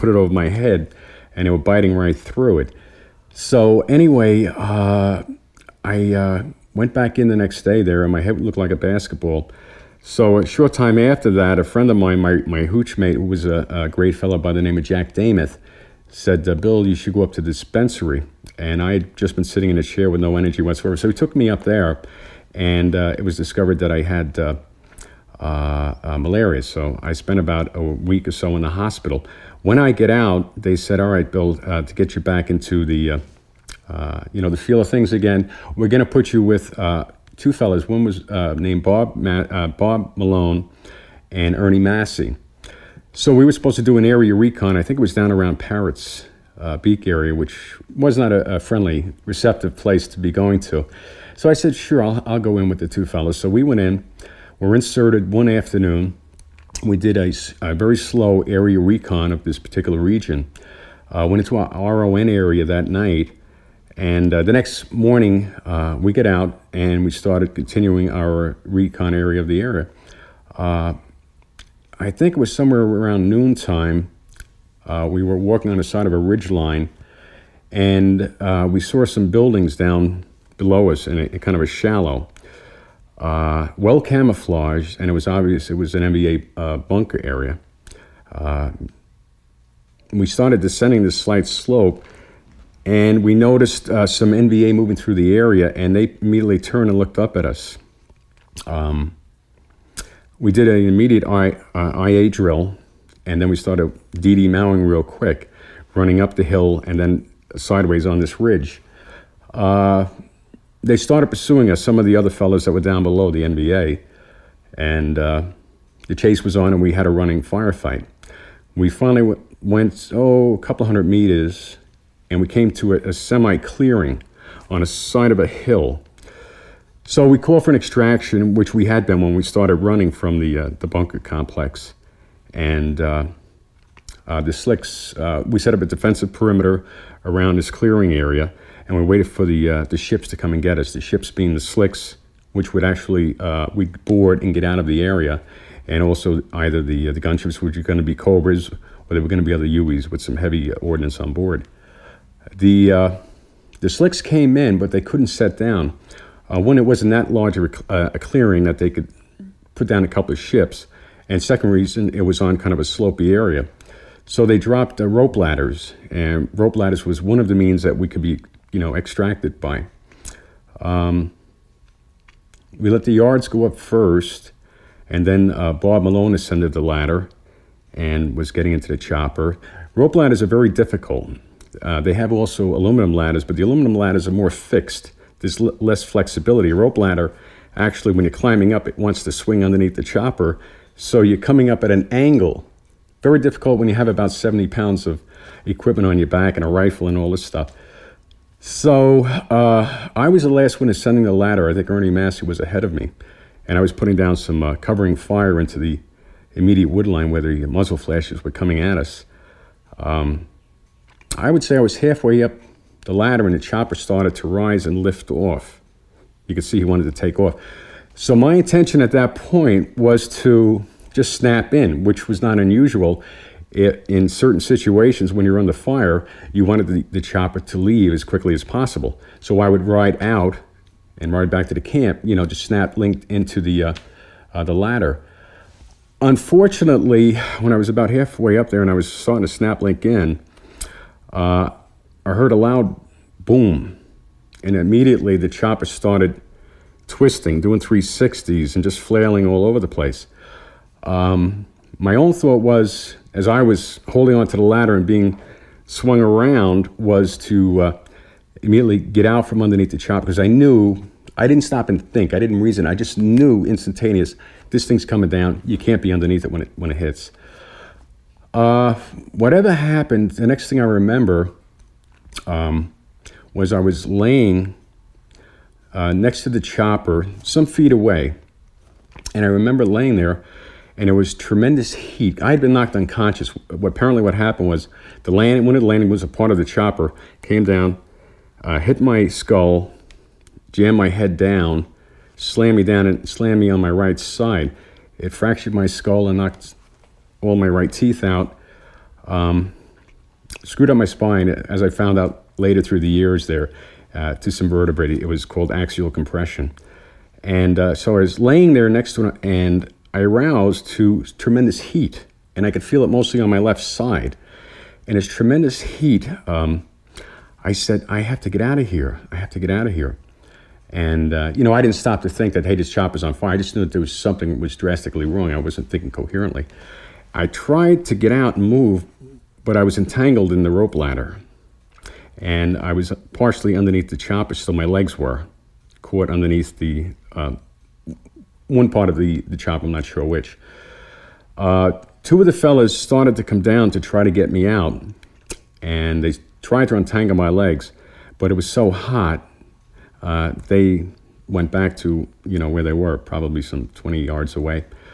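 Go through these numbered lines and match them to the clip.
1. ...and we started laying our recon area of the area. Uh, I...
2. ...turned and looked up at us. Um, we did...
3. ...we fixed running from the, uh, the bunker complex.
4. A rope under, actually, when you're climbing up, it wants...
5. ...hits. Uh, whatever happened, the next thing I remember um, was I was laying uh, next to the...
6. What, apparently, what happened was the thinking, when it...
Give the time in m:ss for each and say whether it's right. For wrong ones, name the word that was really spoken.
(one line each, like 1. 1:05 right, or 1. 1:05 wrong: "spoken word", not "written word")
1. 1:06 wrong: "continuing", not "laying"
2. 1:36 right
3. 2:09 wrong: "started", not "fixed"
4. 3:06 wrong: "ladder", not "under"
5. 4:26 right
6. 4:43 wrong: "landing", not "thinking".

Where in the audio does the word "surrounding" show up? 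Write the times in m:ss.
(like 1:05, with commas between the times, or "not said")
not said.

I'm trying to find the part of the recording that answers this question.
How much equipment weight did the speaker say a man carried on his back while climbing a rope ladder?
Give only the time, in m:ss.
3:14.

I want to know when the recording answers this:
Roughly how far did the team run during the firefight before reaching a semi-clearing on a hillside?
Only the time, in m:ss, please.
2:00.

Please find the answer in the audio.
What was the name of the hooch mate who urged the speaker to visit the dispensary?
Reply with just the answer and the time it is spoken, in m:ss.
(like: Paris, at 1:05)
Jack Damoth, at 0:14.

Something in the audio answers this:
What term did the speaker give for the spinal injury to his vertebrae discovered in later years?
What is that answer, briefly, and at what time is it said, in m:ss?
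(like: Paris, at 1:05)
Axial compression, at 5:05.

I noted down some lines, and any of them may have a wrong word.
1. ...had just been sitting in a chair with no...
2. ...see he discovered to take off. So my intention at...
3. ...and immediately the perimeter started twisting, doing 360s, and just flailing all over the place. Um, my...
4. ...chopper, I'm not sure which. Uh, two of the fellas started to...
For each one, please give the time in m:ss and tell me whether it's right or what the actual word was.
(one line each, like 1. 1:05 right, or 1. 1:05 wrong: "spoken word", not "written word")
1. 0:18 right
2. 3:36 wrong: "wanted", not "discovered"
3. 4:04 wrong: "chopper", not "perimeter"
4. 5:39 right.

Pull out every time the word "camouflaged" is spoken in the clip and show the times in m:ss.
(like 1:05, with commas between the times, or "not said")
1:24.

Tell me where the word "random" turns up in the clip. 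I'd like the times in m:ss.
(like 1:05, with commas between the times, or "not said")
not said.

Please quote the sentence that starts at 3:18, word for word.
So uh, I was the last one ascending the ladder.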